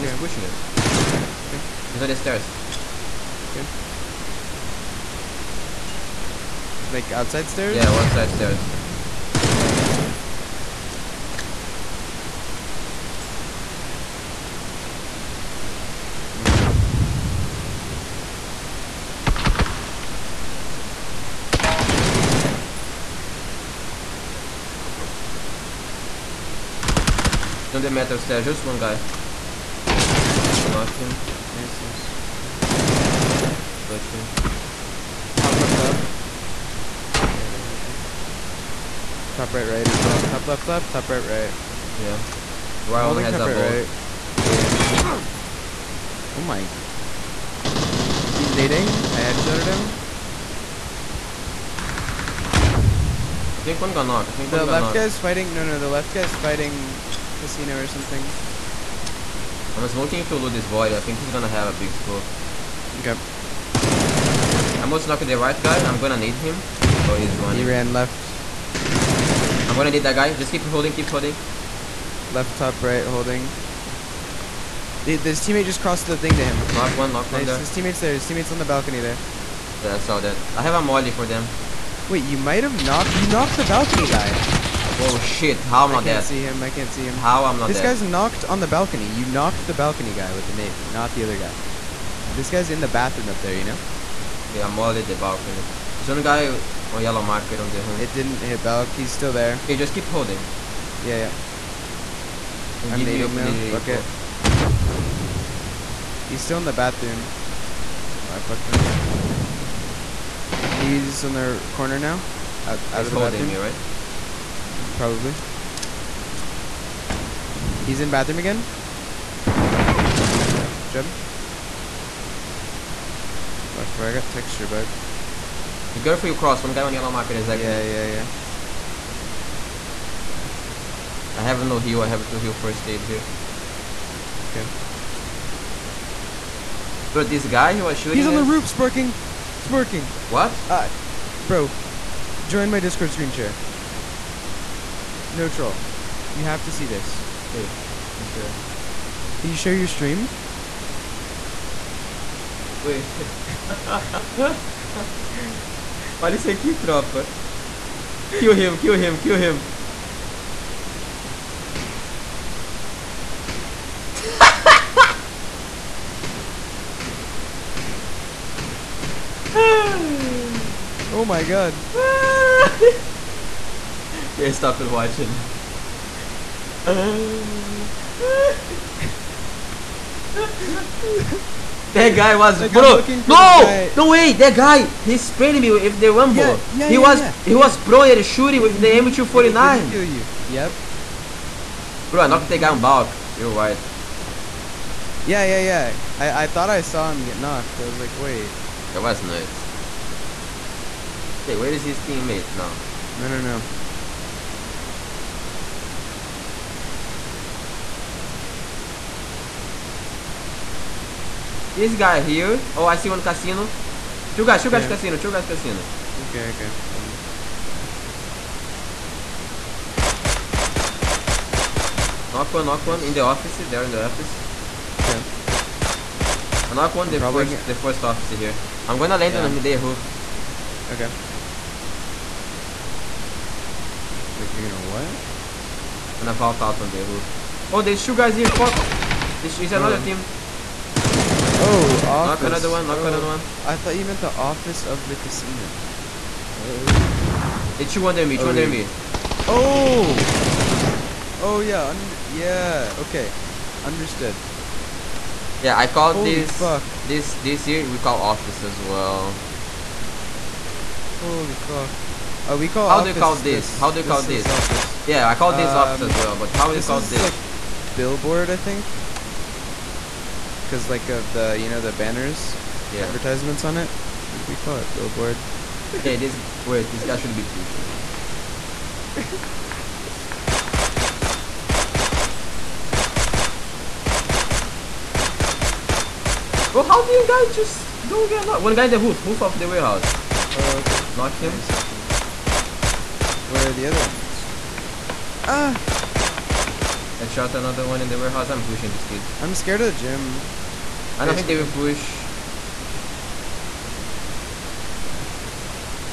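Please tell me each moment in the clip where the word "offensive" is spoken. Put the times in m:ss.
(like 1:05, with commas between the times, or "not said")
not said.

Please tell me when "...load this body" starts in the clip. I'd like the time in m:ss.
1:00.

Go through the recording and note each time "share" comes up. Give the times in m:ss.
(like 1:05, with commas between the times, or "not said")
2:23, 2:29.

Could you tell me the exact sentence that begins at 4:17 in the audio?
this this here we call office as well.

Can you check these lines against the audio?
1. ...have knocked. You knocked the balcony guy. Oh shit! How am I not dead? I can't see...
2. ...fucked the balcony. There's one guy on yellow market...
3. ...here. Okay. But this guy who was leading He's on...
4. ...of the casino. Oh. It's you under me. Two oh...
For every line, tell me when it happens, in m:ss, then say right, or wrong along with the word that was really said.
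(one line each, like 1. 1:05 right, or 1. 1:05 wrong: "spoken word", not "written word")
1. 1:22 right
2. 1:34 wrong: "mollied", not "fucked"
3. 2:13 wrong: "shooting", not "leading"
4. 4:04 right.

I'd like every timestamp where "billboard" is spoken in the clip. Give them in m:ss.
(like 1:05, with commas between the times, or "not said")
4:27, 4:34.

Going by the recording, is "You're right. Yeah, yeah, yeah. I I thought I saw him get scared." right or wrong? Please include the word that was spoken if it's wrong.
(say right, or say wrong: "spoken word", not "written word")
wrong: "knocked", not "scared".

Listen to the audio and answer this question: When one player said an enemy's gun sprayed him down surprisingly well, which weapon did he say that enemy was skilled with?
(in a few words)
M249.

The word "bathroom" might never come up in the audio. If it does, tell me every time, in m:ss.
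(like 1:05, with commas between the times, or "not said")
1:32, 1:46, 1:53, 1:58.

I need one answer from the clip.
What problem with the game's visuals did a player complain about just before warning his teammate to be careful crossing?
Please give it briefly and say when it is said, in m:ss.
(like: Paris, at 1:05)
texture bug, at 2:04.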